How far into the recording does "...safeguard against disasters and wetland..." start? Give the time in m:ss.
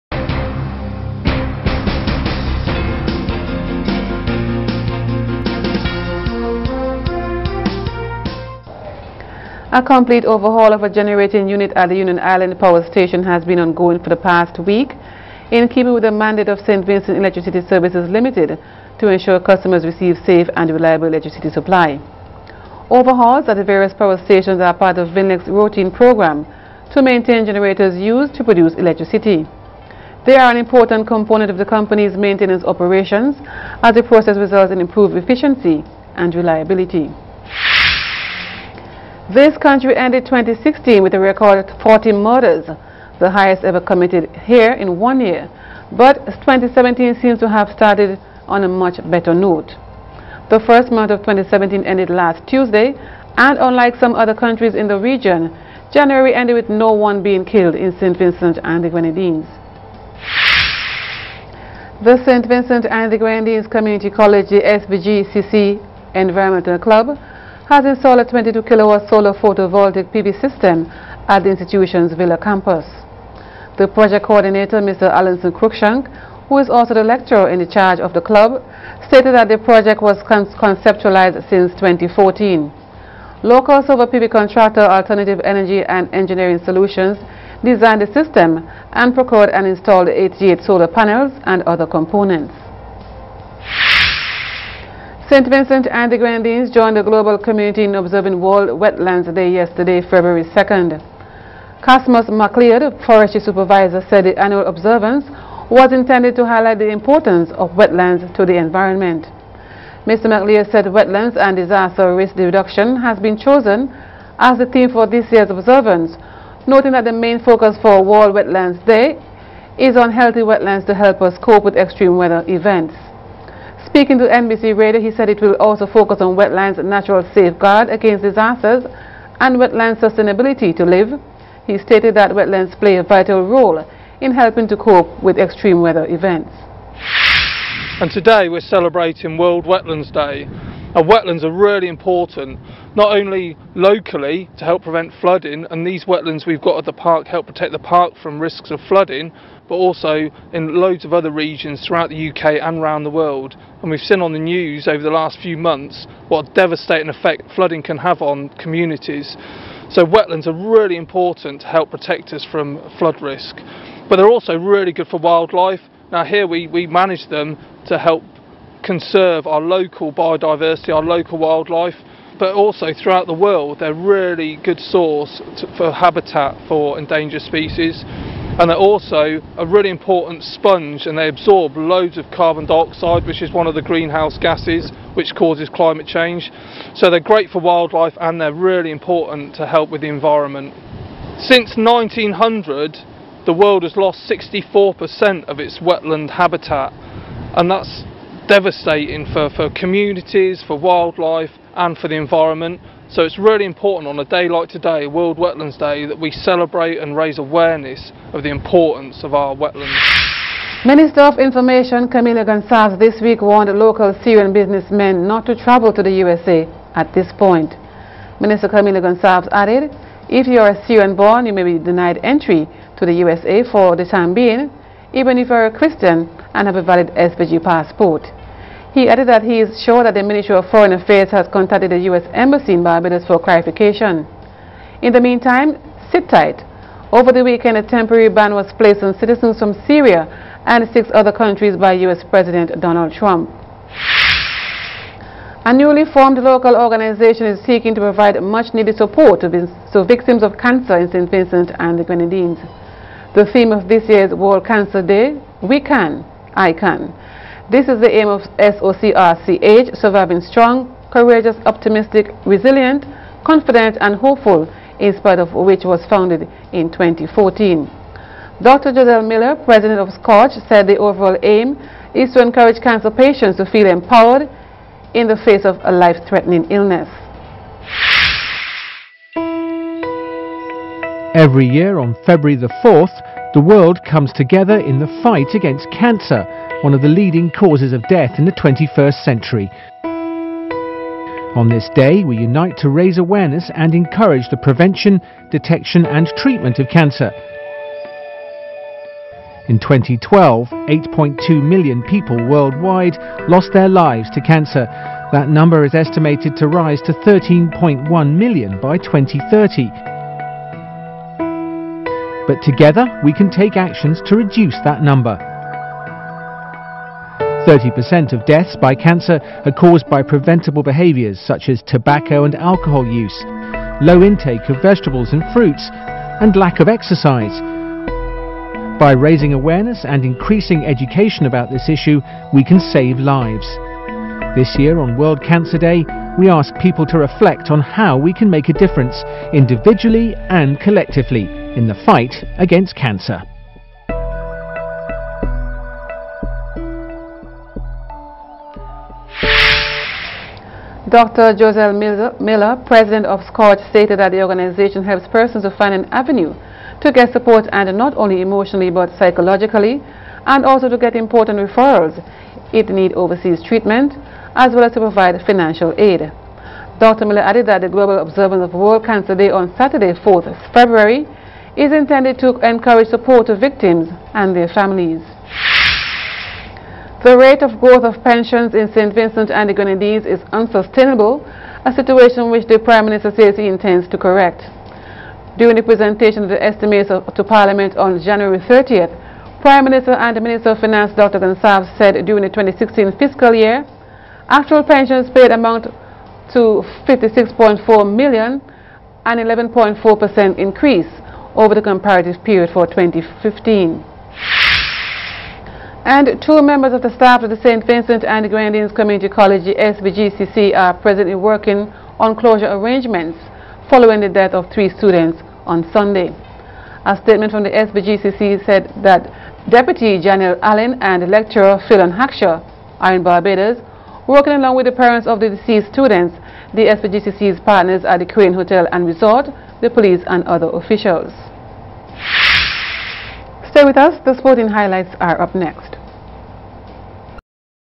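2:07.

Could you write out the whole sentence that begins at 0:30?
They are an important component of the company's maintenance operations as the process results in improved efficiency and reliability.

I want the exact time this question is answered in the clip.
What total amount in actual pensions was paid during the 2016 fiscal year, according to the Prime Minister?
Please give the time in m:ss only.
6:37.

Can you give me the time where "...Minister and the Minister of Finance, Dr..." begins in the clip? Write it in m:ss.
6:29.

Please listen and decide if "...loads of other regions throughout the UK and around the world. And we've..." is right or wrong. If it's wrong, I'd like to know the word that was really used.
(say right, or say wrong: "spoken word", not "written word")
right.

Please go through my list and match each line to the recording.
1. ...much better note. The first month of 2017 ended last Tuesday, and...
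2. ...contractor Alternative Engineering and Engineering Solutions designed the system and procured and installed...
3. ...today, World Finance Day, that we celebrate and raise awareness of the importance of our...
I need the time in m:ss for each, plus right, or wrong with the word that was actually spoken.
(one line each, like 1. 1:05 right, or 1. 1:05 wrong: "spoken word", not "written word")
1. 0:48 right
2. 1:24 wrong: "Energy", not "Engineering"
3. 3:24 wrong: "Wetlands", not "Finance".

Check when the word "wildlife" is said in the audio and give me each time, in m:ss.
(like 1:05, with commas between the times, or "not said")
2:45, 2:51, 3:07, 3:20.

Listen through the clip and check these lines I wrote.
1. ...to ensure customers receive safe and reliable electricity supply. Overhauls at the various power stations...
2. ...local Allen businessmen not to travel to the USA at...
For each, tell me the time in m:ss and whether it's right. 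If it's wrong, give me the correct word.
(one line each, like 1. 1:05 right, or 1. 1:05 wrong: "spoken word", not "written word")
1. 0:18 right
2. 3:33 wrong: "Syrian", not "Allen".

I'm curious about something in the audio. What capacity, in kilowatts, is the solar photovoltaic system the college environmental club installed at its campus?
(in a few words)
22 kilowatt.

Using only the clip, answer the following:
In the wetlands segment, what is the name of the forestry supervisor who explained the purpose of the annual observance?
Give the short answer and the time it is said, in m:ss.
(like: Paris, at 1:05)
Cosmos MacLeod, at 1:41.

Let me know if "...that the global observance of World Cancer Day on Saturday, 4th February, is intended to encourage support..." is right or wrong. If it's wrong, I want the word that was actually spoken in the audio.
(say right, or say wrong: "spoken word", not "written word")
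right.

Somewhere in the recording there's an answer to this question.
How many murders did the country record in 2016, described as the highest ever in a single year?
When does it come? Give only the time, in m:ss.
0:41.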